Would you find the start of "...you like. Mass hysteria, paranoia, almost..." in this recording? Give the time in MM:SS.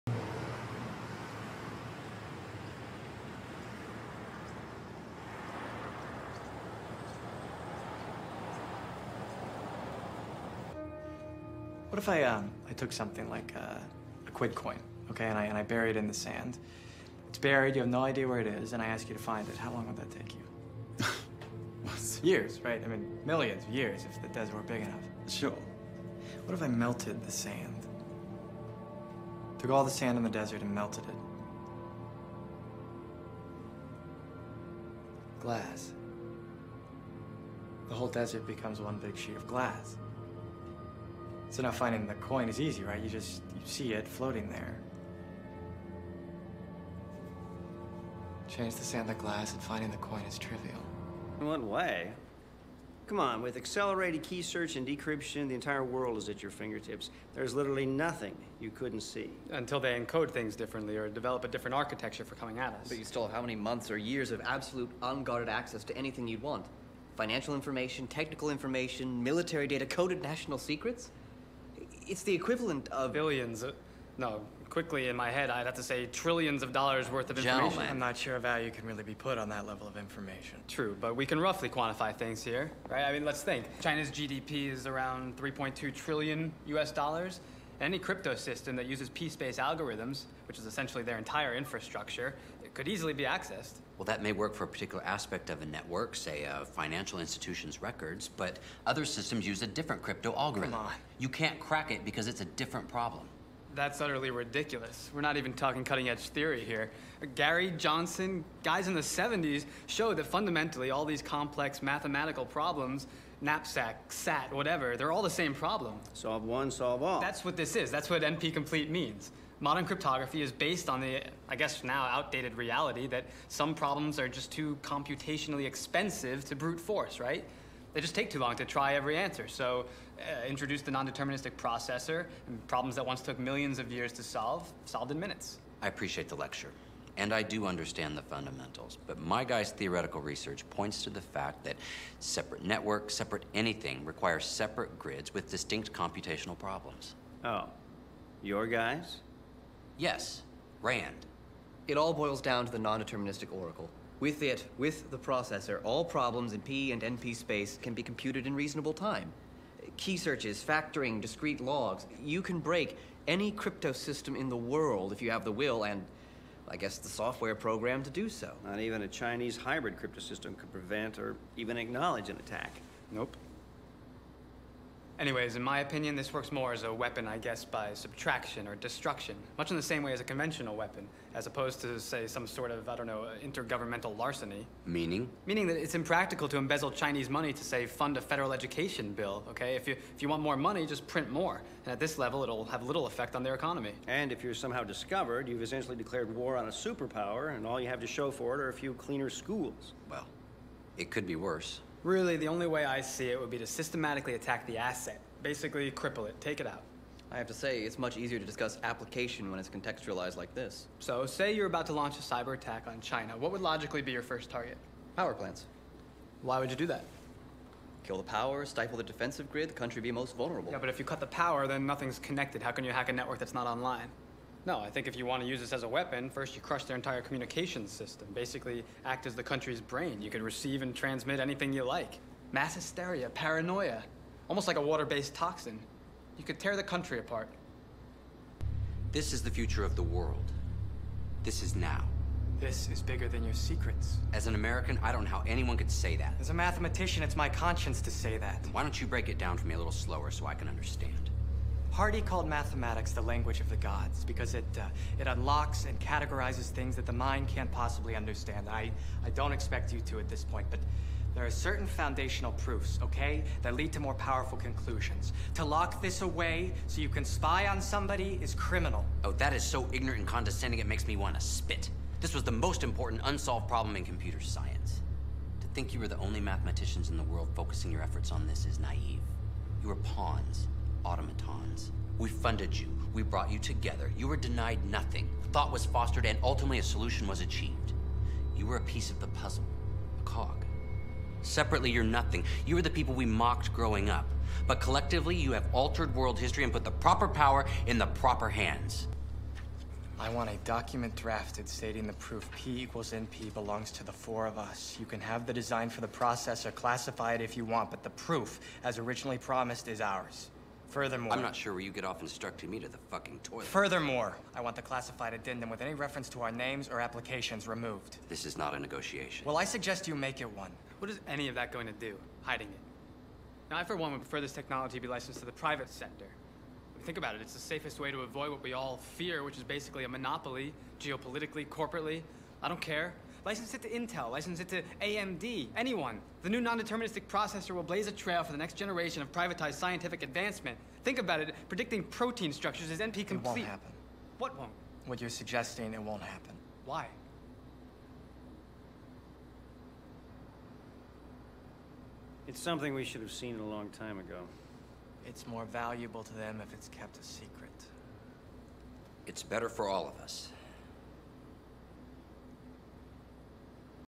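03:51.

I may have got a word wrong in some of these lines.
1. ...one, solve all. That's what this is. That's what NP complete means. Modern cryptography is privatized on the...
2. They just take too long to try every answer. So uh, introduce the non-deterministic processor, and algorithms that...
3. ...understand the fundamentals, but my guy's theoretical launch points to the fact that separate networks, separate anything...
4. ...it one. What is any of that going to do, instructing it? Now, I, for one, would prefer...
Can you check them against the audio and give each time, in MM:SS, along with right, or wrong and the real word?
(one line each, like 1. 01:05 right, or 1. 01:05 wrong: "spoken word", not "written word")
1. 01:56 wrong: "based", not "privatized"
2. 02:07 wrong: "problems", not "algorithms"
3. 02:17 wrong: "research", not "launch"
4. 05:20 wrong: "hiding", not "instructing".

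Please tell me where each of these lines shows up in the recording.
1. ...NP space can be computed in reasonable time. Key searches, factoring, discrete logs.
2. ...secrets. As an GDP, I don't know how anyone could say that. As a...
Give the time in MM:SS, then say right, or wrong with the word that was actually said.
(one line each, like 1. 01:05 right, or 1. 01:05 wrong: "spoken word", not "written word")
1. 02:37 right
2. 04:03 wrong: "American", not "GDP".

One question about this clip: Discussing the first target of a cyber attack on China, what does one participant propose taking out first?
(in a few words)
Power plants.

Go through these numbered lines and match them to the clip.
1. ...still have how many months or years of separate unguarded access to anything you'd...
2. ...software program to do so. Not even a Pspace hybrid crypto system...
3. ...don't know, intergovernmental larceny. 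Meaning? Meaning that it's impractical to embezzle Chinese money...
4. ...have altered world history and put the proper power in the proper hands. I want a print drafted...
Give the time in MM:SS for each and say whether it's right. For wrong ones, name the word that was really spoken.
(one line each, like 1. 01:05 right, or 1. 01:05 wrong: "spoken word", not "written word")
1. 01:03 wrong: "absolute", not "separate"
2. 02:47 wrong: "Chinese", not "Pspace"
3. 03:02 right
4. 04:55 wrong: "document", not "print".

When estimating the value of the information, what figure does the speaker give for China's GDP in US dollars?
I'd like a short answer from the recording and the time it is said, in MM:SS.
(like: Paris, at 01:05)
3.2 trillion, at 01:25.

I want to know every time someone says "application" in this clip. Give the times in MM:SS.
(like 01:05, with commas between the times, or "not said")
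03:28, 05:16.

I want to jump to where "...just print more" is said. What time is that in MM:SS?
03:10.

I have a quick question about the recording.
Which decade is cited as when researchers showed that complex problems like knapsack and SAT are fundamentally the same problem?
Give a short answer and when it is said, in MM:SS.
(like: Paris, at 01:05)
the 70s, at 01:48.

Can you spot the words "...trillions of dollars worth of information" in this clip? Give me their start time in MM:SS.
01:16.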